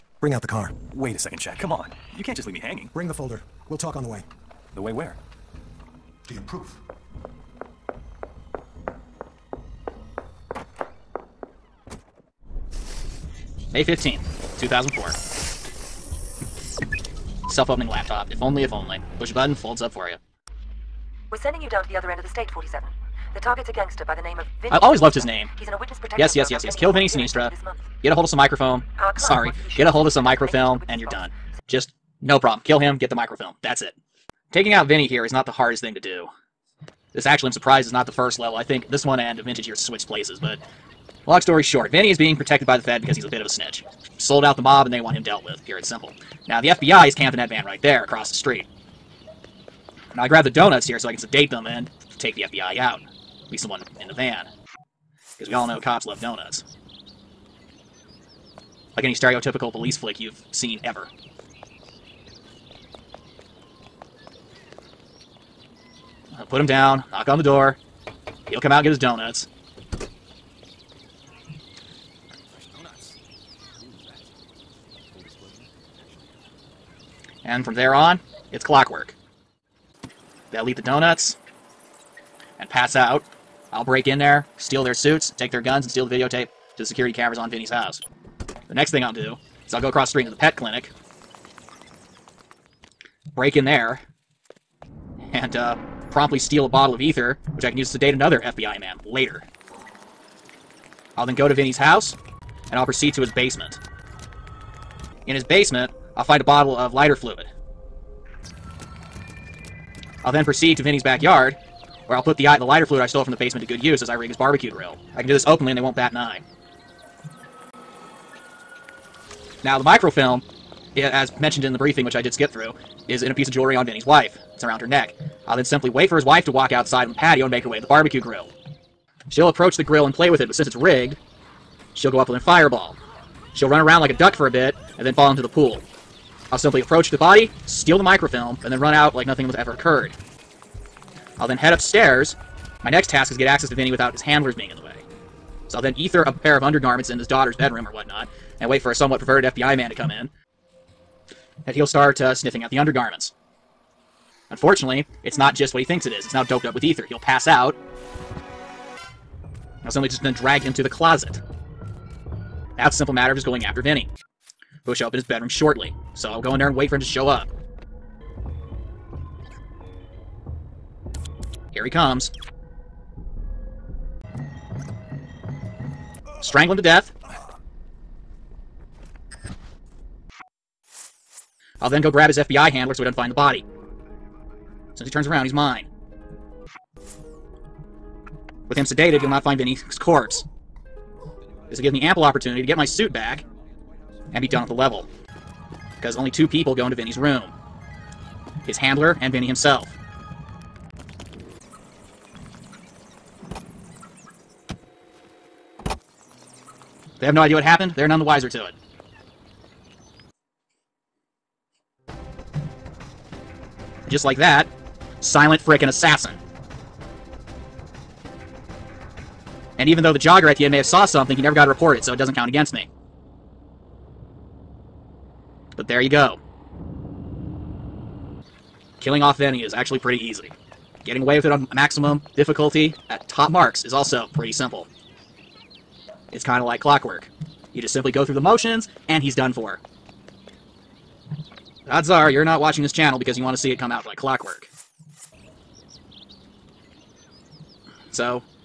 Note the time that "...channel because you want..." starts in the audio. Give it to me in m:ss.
4:02.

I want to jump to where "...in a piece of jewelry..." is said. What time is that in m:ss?
2:03.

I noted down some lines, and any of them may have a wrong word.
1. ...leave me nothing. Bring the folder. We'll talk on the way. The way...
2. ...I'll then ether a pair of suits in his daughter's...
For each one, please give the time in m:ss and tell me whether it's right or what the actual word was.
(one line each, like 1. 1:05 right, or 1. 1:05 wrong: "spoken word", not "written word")
1. 0:02 wrong: "hanging", not "nothing"
2. 2:25 wrong: "undergarments", not "suits".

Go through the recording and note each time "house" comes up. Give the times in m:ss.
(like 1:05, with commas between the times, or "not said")
1:27, 1:41.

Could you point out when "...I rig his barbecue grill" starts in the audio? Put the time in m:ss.
1:54.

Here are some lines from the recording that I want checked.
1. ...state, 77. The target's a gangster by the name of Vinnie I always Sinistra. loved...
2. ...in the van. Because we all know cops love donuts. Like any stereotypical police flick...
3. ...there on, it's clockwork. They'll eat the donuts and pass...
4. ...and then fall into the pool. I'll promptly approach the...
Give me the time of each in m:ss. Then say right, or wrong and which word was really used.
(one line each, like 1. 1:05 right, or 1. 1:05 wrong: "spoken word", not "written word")
1. 0:22 wrong: "47", not "77"
2. 0:54 right
3. 1:17 right
4. 2:14 wrong: "simply", not "promptly".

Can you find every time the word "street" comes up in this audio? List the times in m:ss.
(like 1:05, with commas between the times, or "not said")
0:48, 1:30.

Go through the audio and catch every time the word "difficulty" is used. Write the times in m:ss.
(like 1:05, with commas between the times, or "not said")
3:52.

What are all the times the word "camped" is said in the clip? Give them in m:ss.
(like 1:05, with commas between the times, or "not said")
0:47.